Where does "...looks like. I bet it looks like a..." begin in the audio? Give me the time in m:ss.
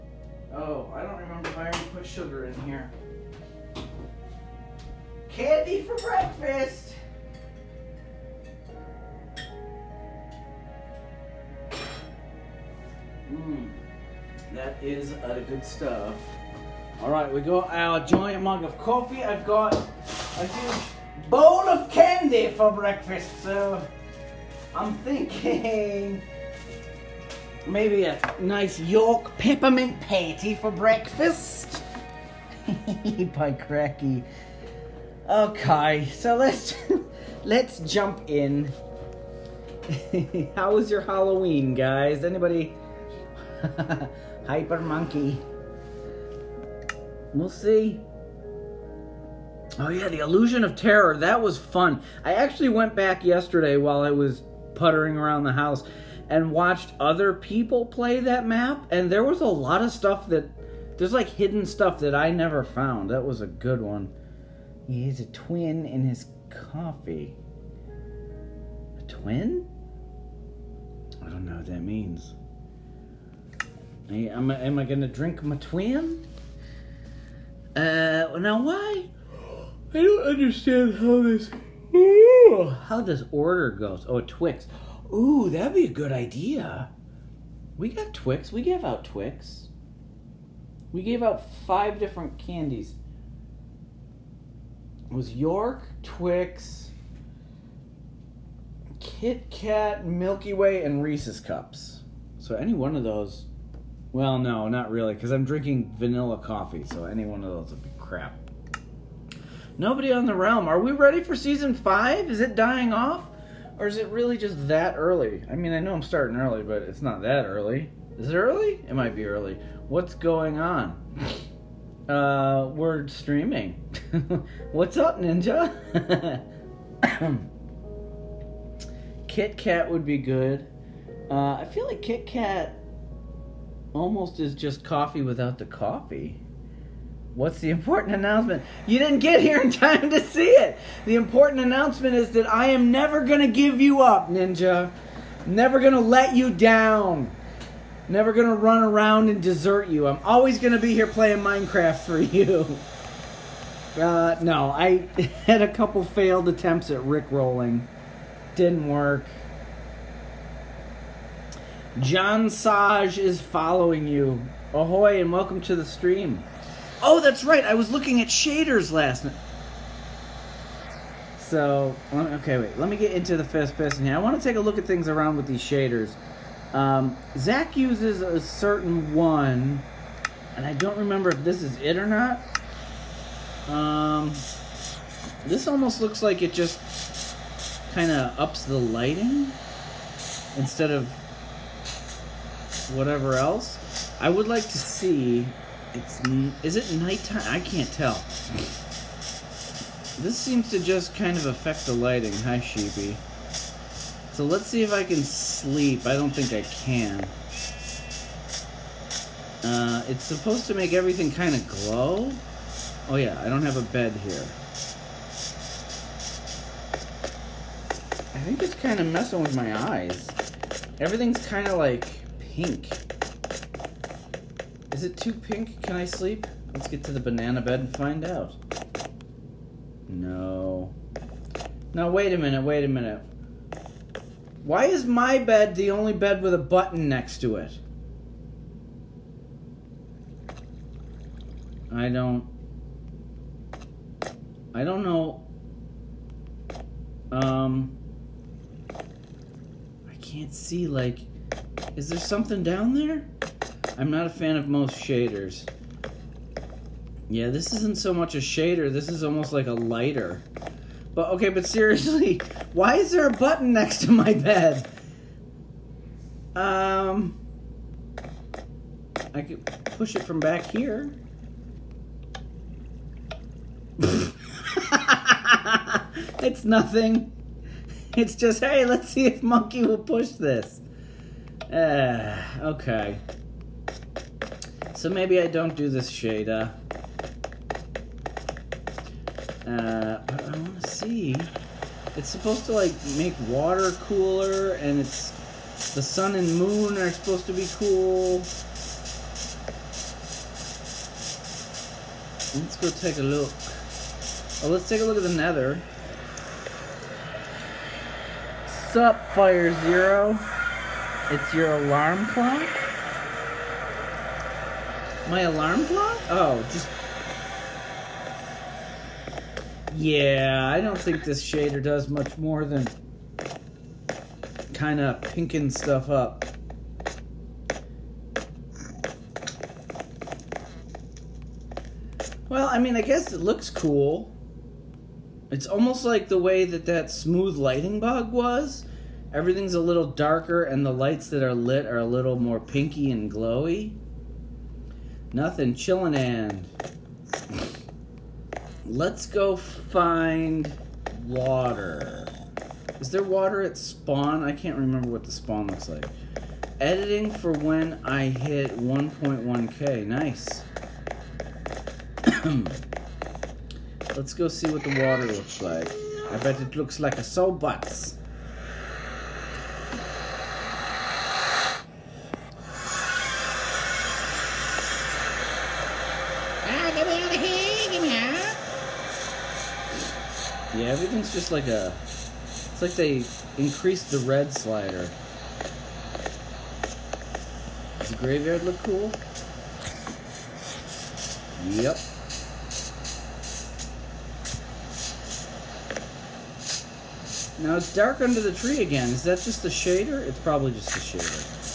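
6:05.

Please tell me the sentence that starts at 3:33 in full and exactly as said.
Oh yeah, I don't have a bed here.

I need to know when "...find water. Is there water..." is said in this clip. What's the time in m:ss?
5:49.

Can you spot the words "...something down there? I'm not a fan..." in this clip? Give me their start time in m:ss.
4:12.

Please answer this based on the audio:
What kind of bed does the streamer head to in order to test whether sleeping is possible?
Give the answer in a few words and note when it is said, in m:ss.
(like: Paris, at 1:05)
banana bed, at 3:47.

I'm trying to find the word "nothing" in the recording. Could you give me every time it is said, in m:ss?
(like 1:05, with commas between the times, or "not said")
4:36, 5:45.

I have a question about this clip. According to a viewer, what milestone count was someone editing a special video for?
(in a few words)
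1.1k.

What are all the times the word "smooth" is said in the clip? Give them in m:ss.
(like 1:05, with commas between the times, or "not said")
5:37.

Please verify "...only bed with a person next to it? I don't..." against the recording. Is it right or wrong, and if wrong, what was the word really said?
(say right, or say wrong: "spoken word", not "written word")
wrong: "button", not "person".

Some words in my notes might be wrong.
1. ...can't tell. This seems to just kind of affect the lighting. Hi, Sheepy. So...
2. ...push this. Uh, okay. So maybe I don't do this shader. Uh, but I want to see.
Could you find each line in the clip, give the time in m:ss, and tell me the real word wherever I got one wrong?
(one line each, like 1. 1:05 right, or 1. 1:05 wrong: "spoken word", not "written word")
1. 3:17 right
2. 4:39 right.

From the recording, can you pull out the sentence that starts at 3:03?
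Um, this almost looks like it just kind of ups the lighting instead of whatever else.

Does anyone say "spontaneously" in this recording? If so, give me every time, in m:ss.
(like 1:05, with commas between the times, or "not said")
not said.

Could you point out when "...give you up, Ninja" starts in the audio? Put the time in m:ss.
2:23.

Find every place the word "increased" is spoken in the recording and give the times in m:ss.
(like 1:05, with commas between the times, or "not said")
6:23.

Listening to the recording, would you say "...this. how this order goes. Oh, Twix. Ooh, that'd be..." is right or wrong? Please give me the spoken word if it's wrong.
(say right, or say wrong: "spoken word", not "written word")
right.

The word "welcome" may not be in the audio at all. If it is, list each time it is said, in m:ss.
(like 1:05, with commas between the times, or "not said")
2:45.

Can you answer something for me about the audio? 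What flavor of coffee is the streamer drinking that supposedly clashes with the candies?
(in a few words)
vanilla.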